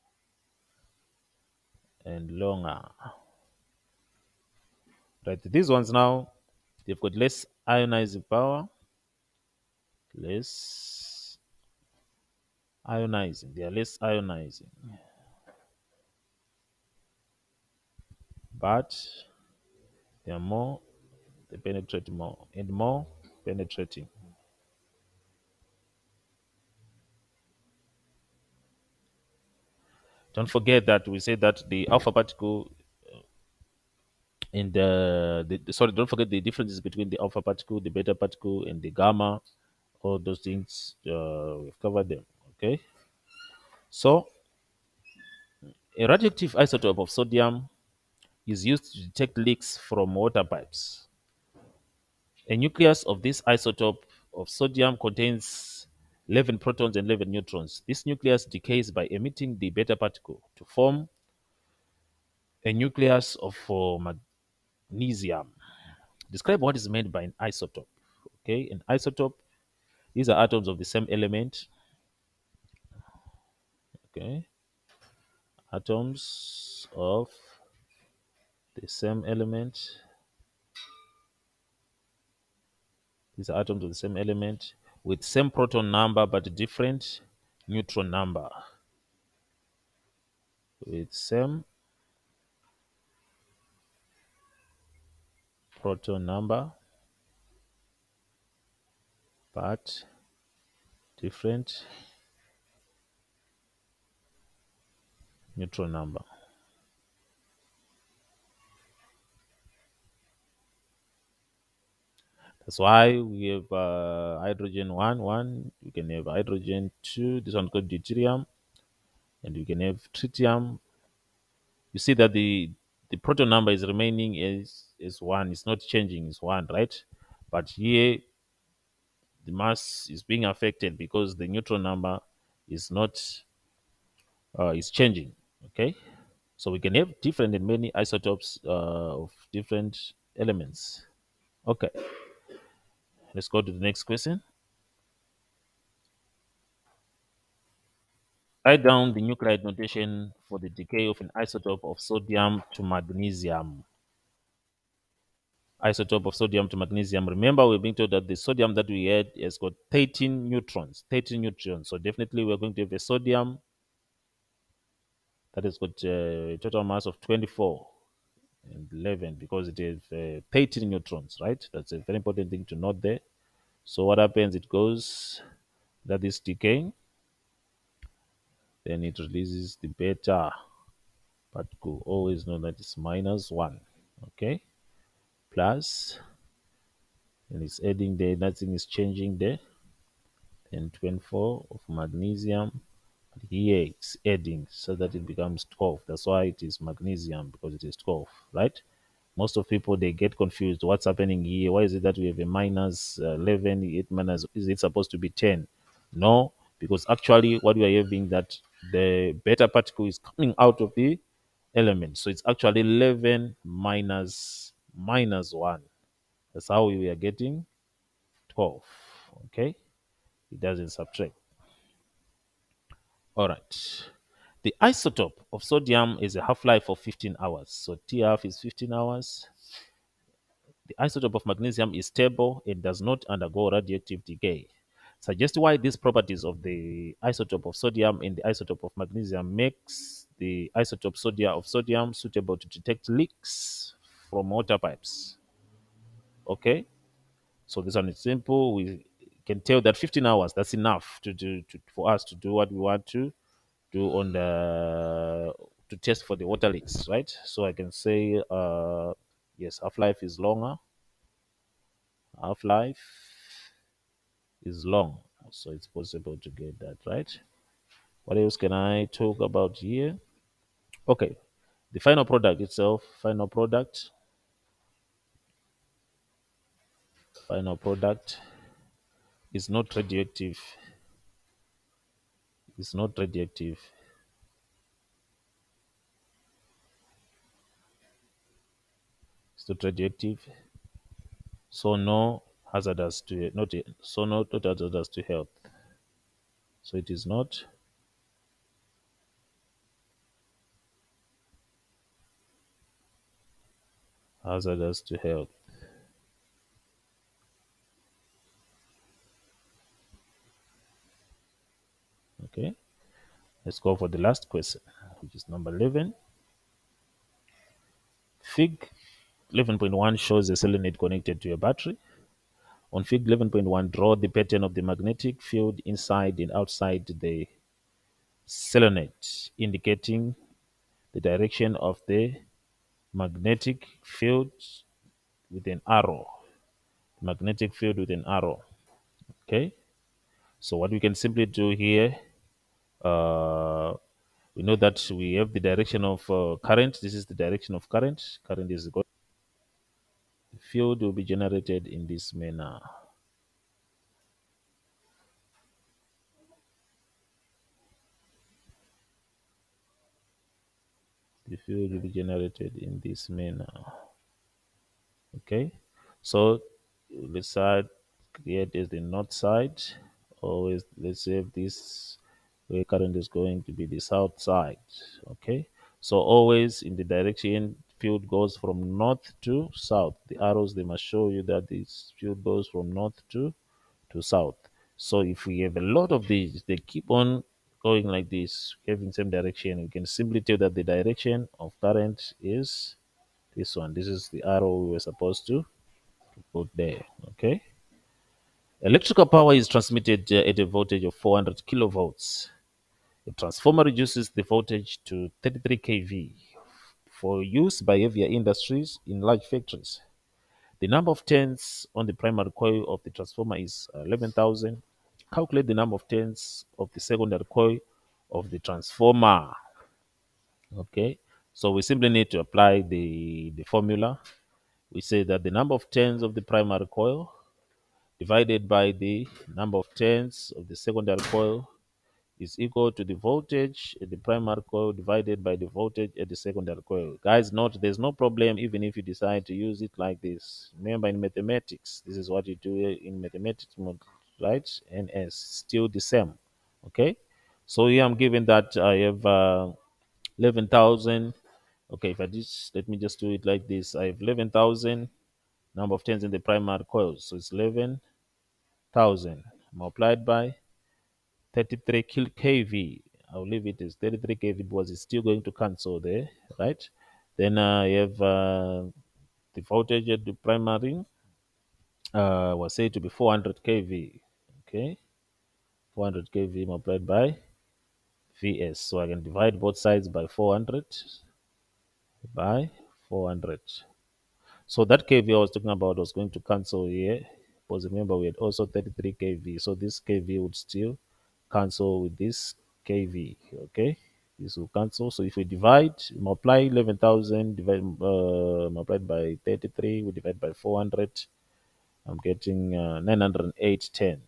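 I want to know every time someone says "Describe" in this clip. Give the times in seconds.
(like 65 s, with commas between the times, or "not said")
66 s.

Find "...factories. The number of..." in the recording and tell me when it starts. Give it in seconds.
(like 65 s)
409 s.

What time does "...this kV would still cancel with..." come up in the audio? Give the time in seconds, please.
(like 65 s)
489 s.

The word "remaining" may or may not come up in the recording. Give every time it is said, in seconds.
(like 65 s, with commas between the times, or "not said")
123 s.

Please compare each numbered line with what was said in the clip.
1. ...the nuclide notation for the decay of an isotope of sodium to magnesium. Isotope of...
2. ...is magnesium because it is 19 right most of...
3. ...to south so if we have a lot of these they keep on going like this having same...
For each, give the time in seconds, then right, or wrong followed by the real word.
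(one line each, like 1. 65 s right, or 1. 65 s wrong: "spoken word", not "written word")
1. 149 s right
2. 196 s wrong: "12", not "19"
3. 384 s right.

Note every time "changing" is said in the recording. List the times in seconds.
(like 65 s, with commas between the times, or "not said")
125 s, 134 s, 188 s.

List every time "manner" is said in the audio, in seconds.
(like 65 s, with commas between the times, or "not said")
352 s, 363 s.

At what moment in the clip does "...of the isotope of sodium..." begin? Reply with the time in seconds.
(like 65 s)
236 s.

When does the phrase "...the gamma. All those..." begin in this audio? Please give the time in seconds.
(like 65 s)
38 s.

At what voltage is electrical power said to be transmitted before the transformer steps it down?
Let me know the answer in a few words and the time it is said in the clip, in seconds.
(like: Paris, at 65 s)
400 kV, at 401 s.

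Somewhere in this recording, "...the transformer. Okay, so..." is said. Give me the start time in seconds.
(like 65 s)
418 s.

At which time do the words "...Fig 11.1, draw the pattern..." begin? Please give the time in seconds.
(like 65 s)
323 s.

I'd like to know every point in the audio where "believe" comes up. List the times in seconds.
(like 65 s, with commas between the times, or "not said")
463 s.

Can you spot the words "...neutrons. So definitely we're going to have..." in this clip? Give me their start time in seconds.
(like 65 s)
161 s.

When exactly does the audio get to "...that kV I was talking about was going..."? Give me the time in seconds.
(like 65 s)
484 s.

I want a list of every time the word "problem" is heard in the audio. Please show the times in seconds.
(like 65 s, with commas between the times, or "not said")
438 s.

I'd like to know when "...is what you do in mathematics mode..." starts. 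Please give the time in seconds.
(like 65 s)
442 s.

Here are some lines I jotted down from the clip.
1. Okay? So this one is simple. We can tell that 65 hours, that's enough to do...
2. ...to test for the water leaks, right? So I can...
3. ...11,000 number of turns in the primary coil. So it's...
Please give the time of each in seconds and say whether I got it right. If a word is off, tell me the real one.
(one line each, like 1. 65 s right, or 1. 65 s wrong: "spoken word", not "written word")
1. 246 s wrong: "15", not "65"
2. 255 s right
3. 454 s right.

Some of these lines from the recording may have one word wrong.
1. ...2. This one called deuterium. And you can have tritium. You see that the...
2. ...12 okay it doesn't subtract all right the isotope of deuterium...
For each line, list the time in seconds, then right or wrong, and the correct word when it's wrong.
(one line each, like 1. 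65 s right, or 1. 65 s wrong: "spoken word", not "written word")
1. 117 s right
2. 218 s wrong: "sodium", not "deuterium".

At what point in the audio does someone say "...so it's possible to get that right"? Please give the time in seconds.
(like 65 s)
265 s.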